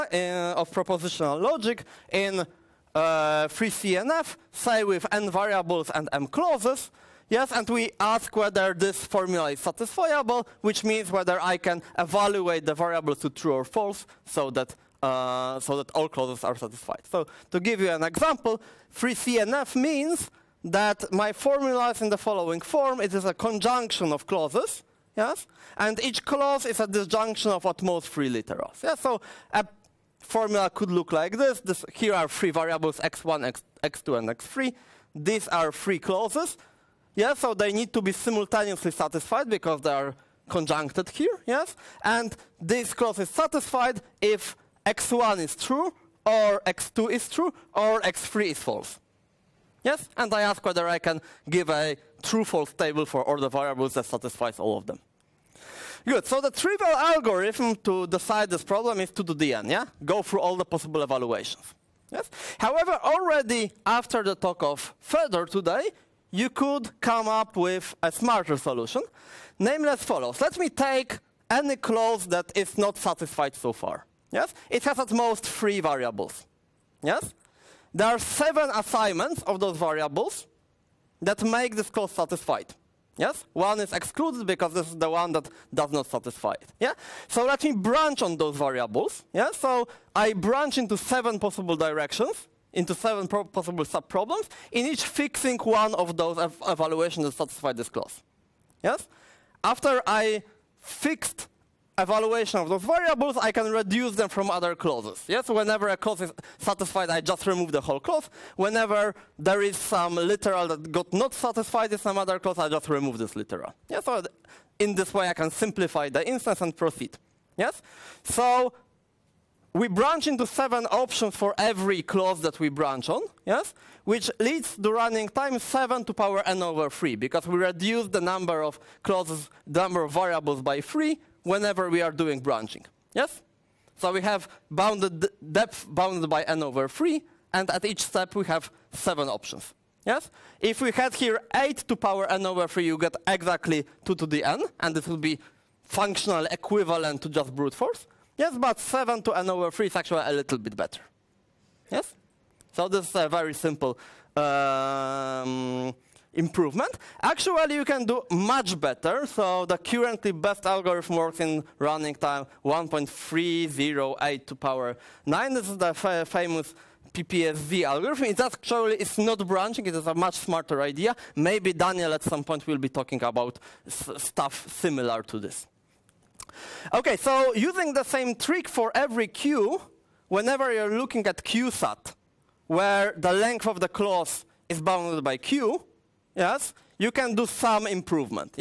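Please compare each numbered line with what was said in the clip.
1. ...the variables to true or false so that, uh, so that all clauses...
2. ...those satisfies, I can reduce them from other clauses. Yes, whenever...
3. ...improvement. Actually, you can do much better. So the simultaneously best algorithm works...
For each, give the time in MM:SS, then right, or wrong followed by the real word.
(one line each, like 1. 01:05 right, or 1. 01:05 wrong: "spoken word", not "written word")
1. 00:12 right
2. 01:42 wrong: "variables", not "satisfies"
3. 02:36 wrong: "currently", not "simultaneously".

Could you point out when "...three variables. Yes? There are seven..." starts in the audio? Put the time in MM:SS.
01:15.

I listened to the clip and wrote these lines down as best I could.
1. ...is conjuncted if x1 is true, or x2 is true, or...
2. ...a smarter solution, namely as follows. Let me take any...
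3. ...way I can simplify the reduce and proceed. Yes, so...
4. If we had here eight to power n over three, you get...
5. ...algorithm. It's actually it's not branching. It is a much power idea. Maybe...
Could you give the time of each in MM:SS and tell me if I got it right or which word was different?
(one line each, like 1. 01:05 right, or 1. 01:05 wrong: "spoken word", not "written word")
1. 00:43 wrong: "satisfied", not "conjuncted"
2. 01:08 right
3. 01:55 wrong: "instance", not "reduce"
4. 02:20 right
5. 02:47 wrong: "smarter", not "power".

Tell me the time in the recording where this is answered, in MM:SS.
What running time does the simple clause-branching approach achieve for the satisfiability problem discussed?
02:05.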